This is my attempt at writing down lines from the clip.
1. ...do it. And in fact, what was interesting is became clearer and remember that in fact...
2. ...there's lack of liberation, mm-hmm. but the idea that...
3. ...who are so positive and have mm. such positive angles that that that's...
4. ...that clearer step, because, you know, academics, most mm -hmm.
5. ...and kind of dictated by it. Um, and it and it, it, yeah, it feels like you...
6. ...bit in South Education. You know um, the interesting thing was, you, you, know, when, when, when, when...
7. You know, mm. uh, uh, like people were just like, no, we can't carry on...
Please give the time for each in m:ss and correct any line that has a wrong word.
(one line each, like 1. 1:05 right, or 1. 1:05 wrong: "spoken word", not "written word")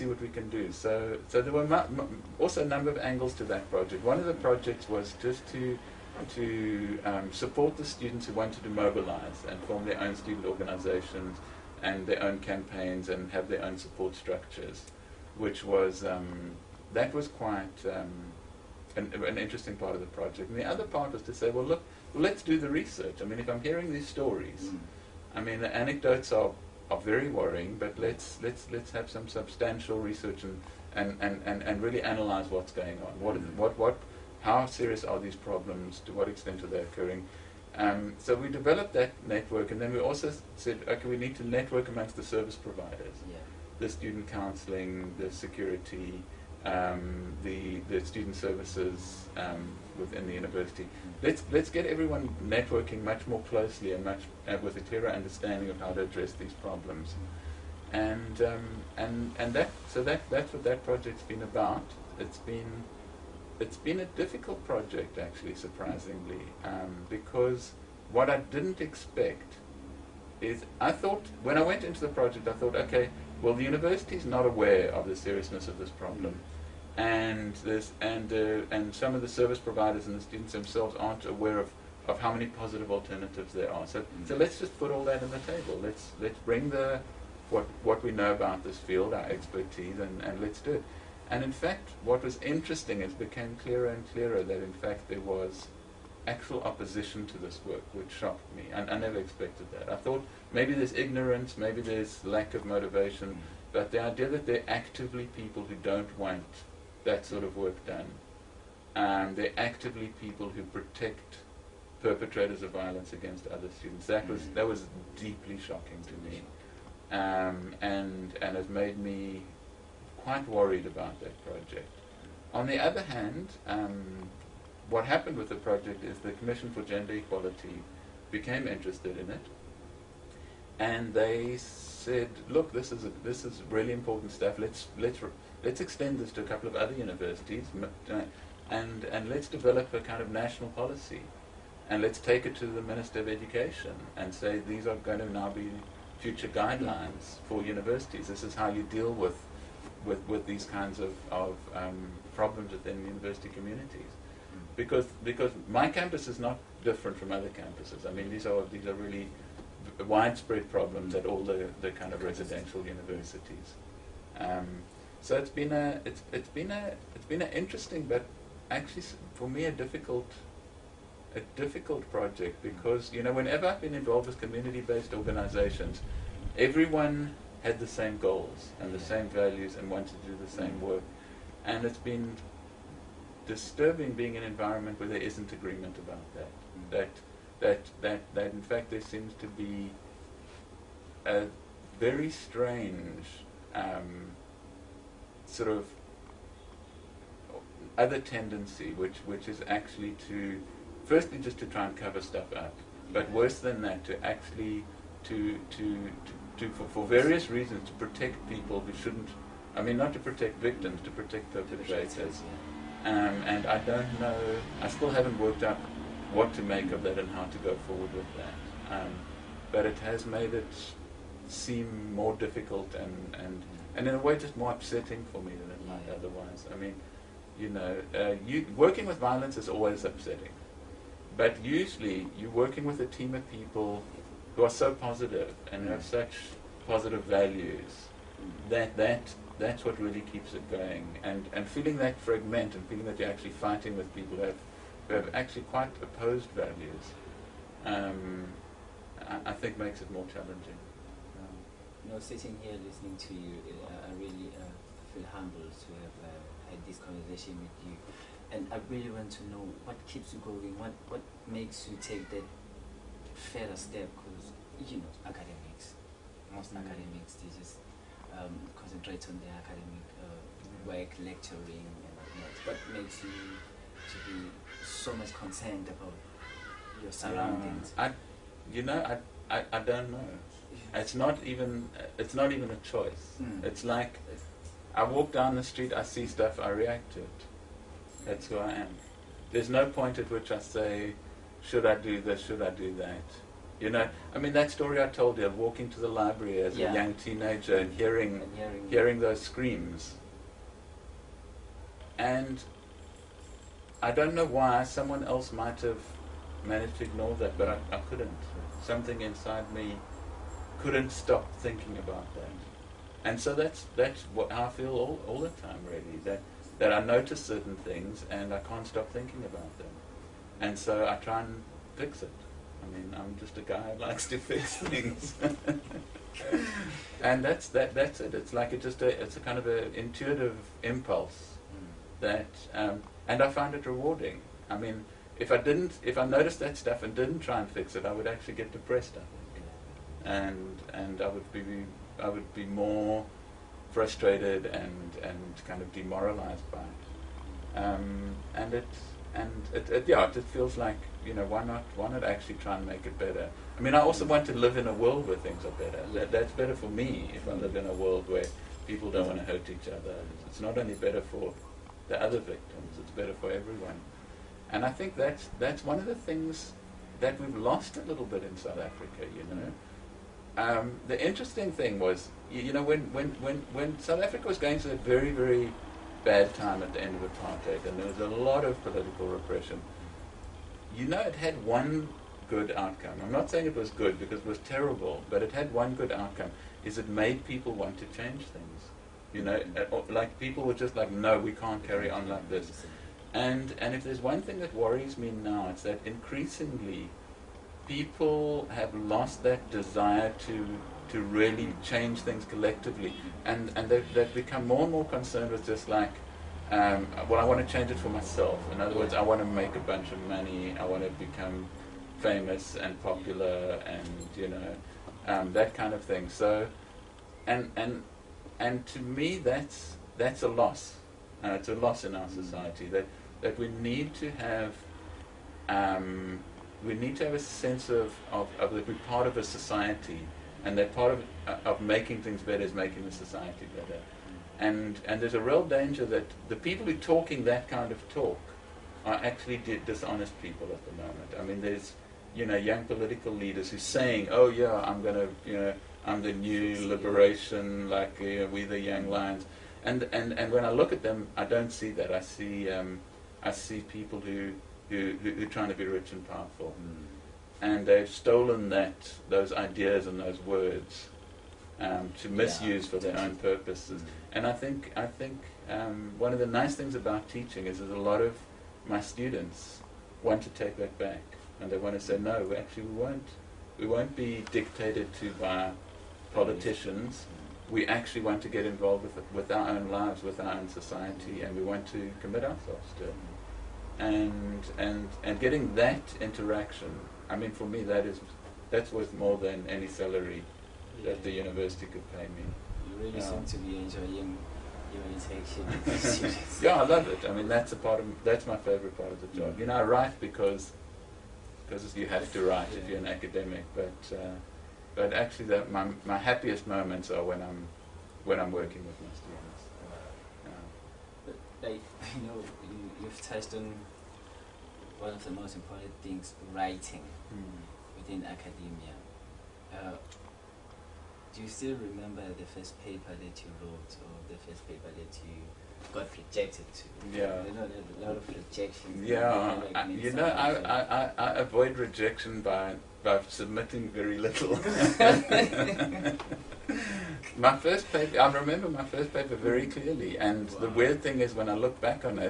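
1. 1:30 wrong: "clearer", not "remember"
2. 1:41 wrong: "motivation", not "liberation"
3. 3:54 wrong: "values", not "angles"
4. 4:22 wrong: "further", not "clearer"
5. 5:45 wrong: "demoralized", not "dictated"
6. 6:08 wrong: "Africa", not "Education"
7. 6:29 right.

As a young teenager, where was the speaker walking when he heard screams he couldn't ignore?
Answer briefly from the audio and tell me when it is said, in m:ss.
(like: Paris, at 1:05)
the library, at 4:56.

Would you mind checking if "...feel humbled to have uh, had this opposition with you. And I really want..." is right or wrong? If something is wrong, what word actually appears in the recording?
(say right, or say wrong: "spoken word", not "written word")
wrong: "conversation", not "opposition".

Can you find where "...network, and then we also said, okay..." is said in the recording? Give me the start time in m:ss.
0:39.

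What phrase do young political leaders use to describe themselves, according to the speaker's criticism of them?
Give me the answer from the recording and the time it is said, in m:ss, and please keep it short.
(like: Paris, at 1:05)
the young lions, at 7:28.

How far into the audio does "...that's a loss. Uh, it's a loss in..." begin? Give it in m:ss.
7:00.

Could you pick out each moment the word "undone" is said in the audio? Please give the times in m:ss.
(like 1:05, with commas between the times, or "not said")
not said.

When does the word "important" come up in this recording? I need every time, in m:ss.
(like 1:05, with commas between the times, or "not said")
2:13, 8:35.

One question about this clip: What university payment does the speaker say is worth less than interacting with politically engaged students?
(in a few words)
any salary.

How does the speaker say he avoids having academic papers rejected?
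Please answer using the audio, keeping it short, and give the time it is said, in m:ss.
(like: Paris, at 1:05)
submitting very little, at 8:53.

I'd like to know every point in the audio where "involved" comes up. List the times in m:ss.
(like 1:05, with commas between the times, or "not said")
2:53, 7:58.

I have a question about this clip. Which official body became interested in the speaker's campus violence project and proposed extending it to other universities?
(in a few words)
Commission for Gender Equality.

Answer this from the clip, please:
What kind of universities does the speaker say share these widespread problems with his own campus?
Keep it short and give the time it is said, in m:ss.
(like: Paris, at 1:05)
residential universities, at 2:42.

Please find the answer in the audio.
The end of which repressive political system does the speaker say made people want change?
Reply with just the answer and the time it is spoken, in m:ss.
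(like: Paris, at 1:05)
apartheid, at 6:17.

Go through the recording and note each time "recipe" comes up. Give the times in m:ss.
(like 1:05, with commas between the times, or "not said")
not said.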